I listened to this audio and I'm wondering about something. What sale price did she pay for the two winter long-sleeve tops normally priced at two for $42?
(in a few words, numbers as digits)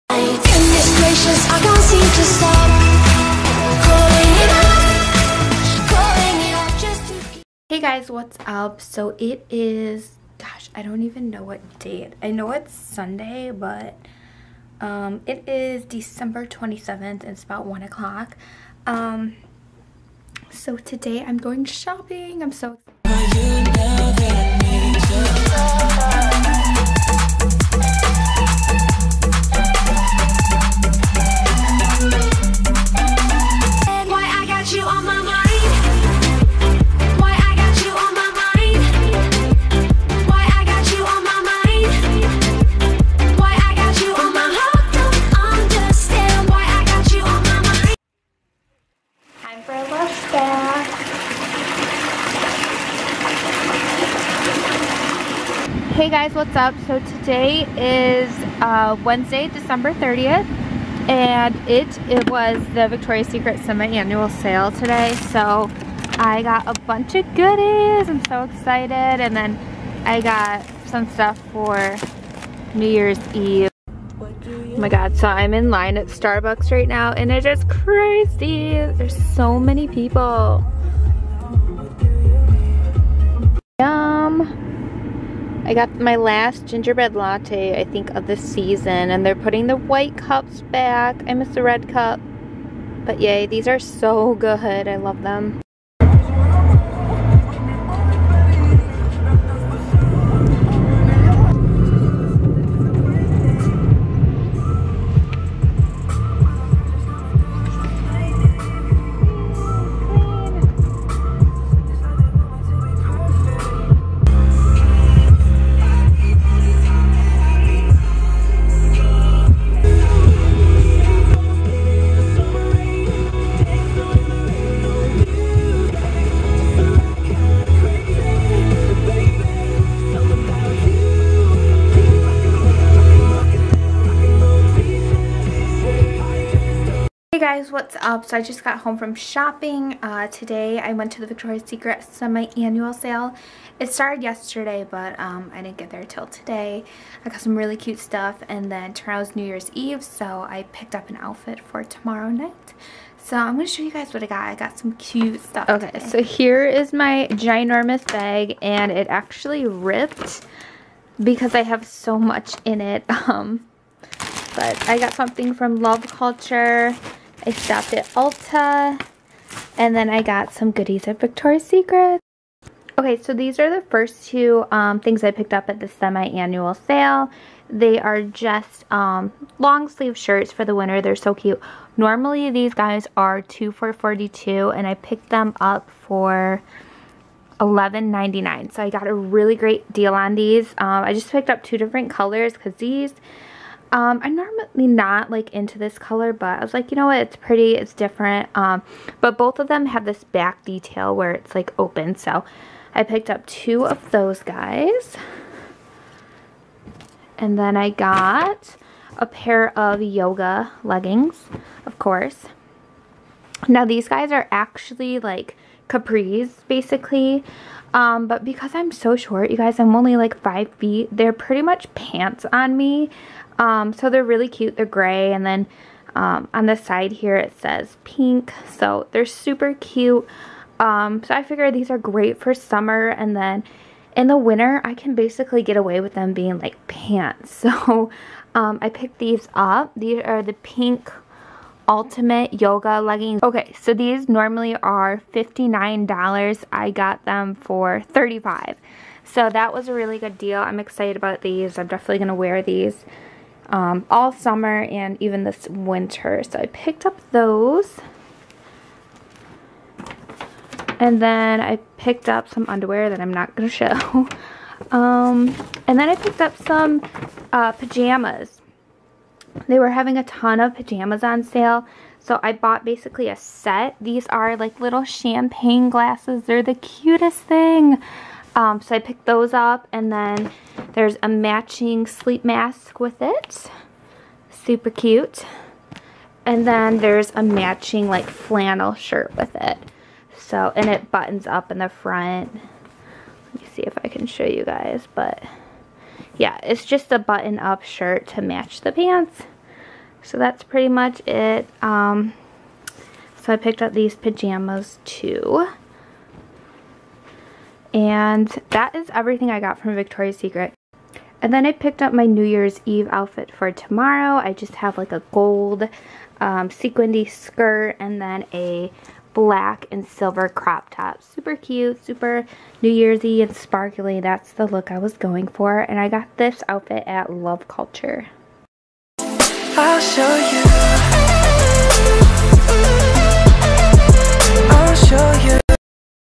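$11.99.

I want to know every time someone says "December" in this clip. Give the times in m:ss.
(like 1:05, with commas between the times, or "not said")
0:15, 0:59.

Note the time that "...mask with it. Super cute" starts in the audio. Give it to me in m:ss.
4:42.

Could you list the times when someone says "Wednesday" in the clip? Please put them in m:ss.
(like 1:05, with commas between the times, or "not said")
0:59.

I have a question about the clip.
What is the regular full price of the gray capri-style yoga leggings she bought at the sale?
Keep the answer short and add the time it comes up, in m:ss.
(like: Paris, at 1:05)
$59, at 4:05.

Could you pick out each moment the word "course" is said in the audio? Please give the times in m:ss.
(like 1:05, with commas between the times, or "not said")
3:31.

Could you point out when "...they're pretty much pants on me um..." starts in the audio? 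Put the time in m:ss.
3:41.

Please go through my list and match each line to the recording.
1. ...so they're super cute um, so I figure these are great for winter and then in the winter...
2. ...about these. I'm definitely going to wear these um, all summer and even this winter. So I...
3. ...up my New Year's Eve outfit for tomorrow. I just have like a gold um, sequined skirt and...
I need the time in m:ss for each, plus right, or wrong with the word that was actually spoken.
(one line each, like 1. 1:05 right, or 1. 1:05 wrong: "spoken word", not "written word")
1. 3:48 wrong: "summer", not "winter"
2. 4:11 right
3. 5:12 right.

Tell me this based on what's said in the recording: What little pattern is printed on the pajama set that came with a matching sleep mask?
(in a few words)
Champagne glasses.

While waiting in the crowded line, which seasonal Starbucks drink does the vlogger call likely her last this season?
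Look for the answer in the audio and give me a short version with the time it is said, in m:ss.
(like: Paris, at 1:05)
Gingerbread latte, at 1:26.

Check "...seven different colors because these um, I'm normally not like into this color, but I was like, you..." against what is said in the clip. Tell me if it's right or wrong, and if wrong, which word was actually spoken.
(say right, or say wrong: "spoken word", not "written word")
wrong: "two", not "seven".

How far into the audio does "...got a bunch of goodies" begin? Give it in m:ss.
1:06.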